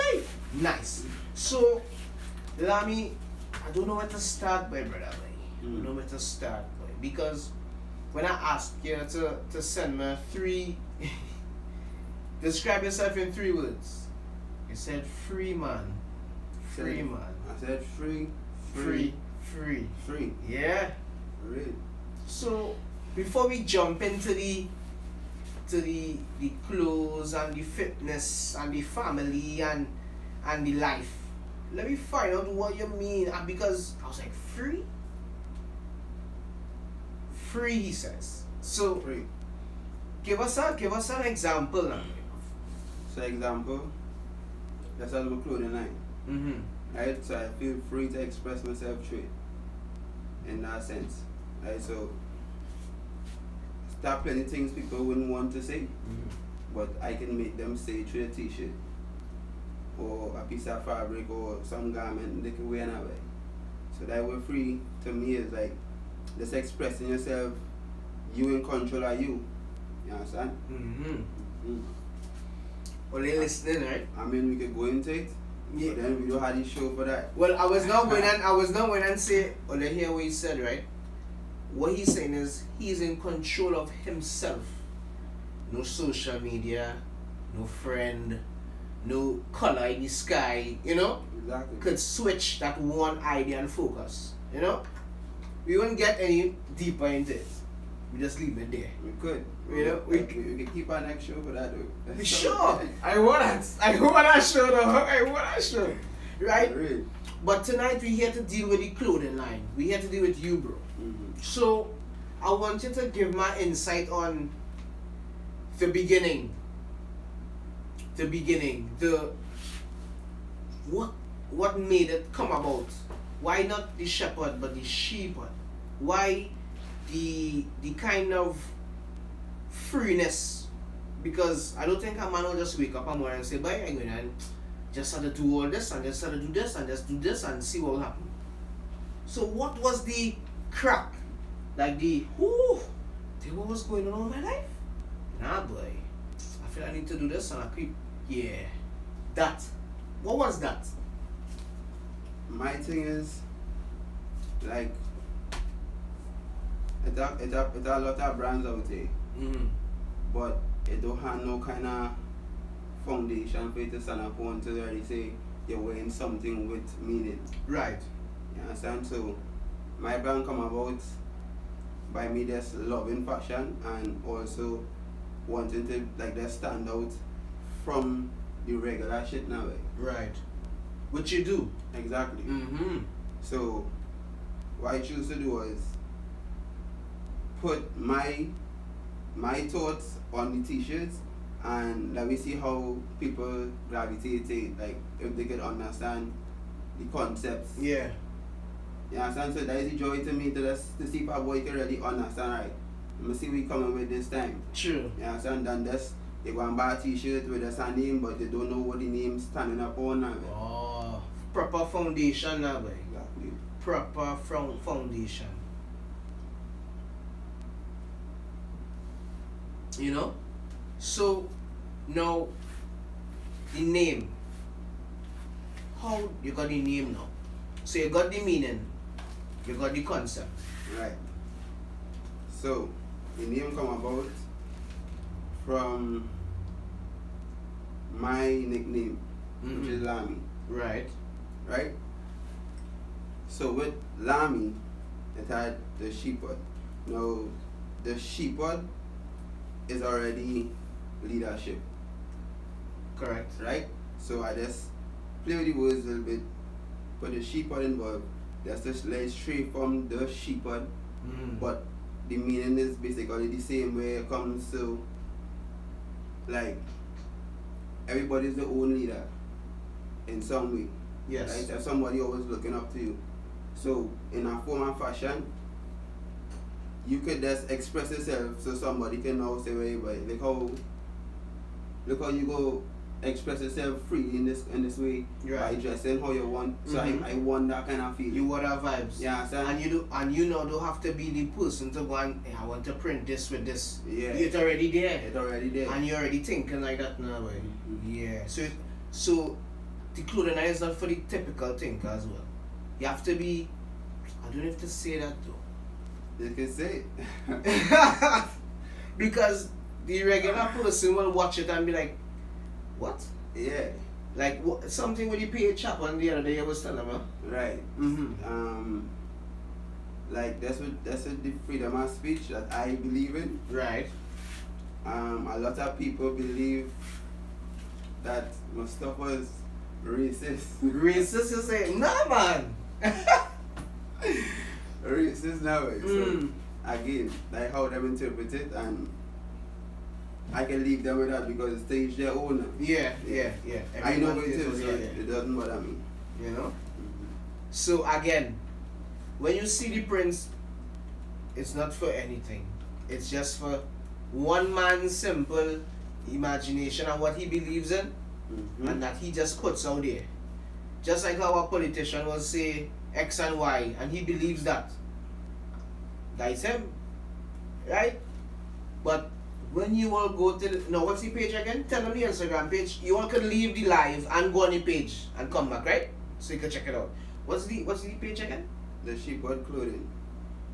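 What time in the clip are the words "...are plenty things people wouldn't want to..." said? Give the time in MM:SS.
00:54.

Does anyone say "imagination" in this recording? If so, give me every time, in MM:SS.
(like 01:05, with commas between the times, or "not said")
05:56.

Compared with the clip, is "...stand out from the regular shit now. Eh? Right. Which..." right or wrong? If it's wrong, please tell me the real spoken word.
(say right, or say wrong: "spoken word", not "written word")
right.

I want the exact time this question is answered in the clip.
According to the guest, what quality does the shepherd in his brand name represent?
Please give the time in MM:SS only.
04:11.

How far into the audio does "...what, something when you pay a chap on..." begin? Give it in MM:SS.
05:14.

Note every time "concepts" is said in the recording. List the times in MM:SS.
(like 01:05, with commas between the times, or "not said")
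03:17, 03:50.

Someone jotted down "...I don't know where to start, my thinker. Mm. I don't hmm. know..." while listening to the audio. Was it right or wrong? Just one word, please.
wrong.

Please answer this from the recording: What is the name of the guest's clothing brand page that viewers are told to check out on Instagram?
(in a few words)
The Sheepard Clothing.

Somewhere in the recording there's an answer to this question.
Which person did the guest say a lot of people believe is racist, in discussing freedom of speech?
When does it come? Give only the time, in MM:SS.
05:28.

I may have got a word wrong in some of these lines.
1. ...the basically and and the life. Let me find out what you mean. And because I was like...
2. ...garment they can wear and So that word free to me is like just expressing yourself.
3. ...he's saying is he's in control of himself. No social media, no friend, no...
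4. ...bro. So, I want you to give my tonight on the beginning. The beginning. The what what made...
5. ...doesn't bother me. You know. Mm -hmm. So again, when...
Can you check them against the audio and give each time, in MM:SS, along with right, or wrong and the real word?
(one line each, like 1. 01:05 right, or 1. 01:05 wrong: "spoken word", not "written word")
1. 00:28 wrong: "family", not "basically"
2. 01:01 right
3. 01:21 right
4. 01:50 wrong: "insight", not "tonight"
5. 05:45 right.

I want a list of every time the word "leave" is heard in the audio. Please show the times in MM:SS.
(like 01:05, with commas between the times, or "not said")
01:38, 05:40, 06:13.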